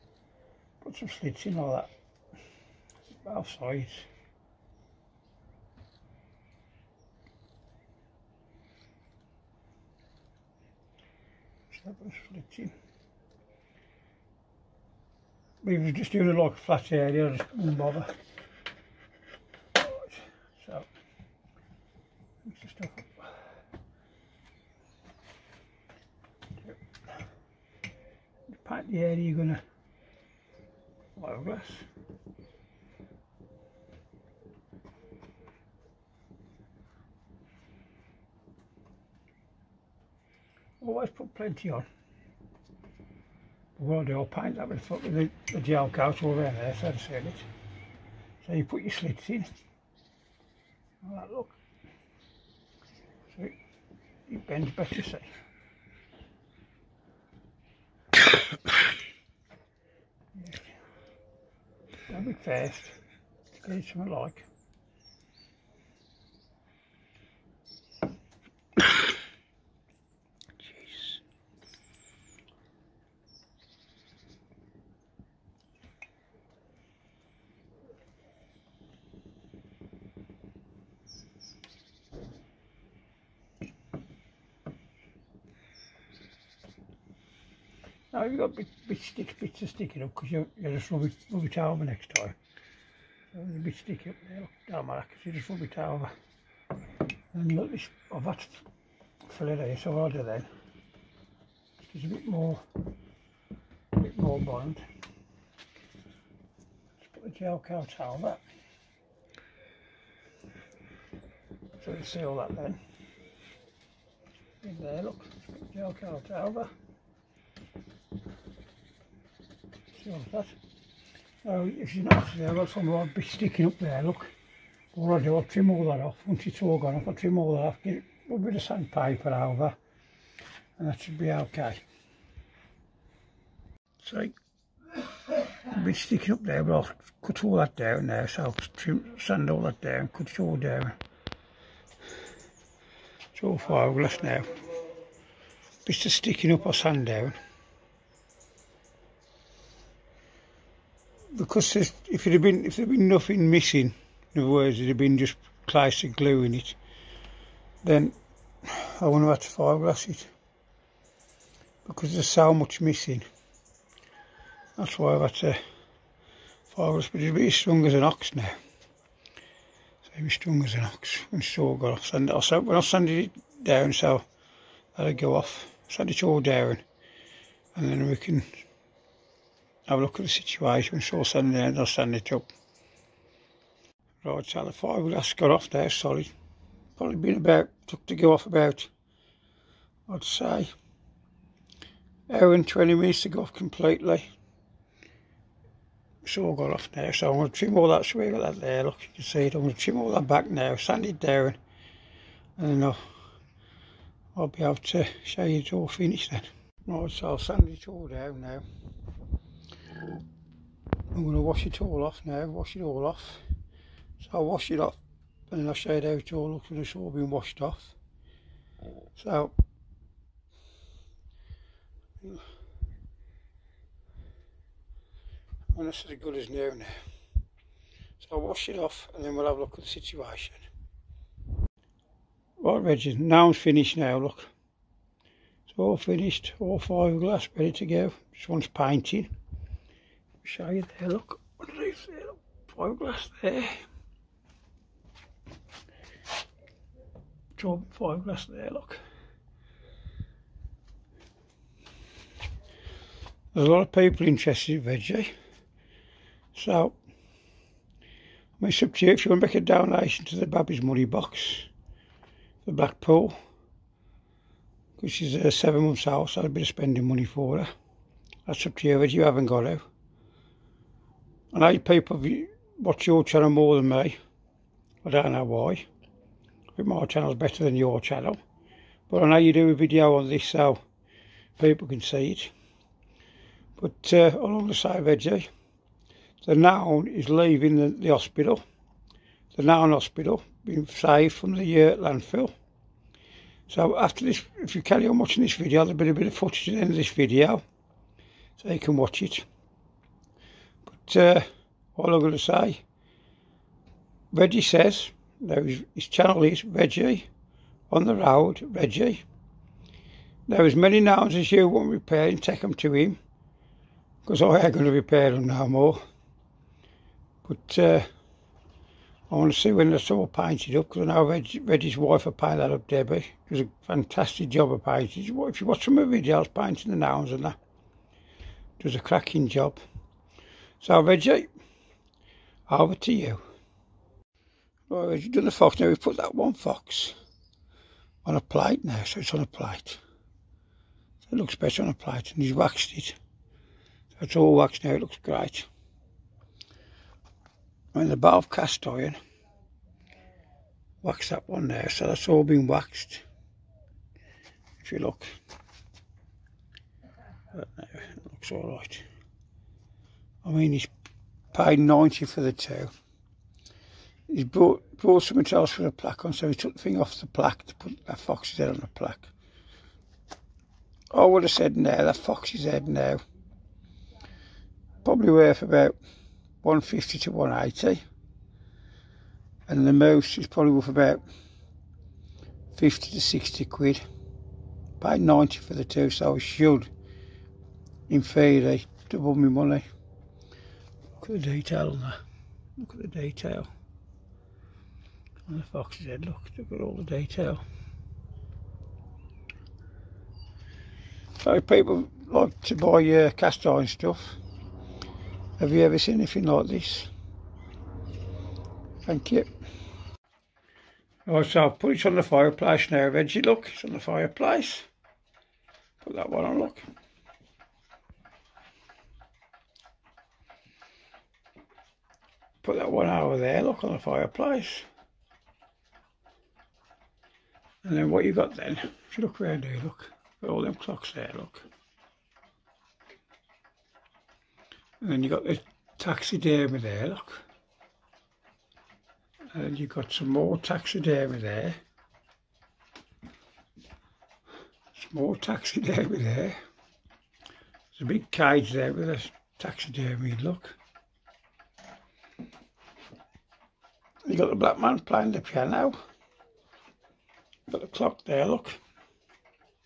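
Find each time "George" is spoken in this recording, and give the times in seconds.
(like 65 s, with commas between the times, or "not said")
not said.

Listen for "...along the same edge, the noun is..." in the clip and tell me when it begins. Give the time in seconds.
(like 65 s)
284 s.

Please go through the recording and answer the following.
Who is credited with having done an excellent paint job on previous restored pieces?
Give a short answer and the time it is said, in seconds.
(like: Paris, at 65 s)
Debbie, at 322 s.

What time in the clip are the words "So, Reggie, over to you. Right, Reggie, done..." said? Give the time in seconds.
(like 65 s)
330 s.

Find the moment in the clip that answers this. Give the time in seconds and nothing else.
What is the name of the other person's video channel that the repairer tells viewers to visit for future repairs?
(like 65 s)
306 s.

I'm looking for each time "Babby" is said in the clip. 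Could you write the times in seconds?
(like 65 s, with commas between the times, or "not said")
260 s.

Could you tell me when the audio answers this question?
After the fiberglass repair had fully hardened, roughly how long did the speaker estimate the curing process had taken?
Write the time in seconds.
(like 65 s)
192 s.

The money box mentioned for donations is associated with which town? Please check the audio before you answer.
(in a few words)
Blackpool.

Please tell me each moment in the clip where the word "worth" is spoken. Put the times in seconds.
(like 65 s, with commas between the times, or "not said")
375 s, 380 s.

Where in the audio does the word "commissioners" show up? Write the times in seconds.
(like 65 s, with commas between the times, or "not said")
not said.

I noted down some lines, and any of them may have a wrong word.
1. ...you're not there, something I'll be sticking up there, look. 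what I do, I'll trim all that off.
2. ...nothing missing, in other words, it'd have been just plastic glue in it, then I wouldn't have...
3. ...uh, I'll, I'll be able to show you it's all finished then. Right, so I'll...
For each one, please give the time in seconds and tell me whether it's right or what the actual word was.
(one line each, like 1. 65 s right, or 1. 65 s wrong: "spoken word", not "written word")
1. 121 s right
2. 153 s right
3. 202 s right.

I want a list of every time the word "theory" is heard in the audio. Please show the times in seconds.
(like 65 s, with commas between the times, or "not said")
388 s.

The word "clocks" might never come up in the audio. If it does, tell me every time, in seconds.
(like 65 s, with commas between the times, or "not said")
430 s, 457 s.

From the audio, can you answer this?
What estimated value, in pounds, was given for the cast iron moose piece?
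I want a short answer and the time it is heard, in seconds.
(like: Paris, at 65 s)
50 to 60, at 382 s.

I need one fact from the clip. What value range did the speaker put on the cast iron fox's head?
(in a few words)
150 to 180.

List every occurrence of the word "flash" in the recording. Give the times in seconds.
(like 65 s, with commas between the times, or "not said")
not said.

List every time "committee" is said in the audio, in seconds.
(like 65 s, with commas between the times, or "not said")
not said.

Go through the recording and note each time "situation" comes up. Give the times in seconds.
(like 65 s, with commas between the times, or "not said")
180 s, 229 s.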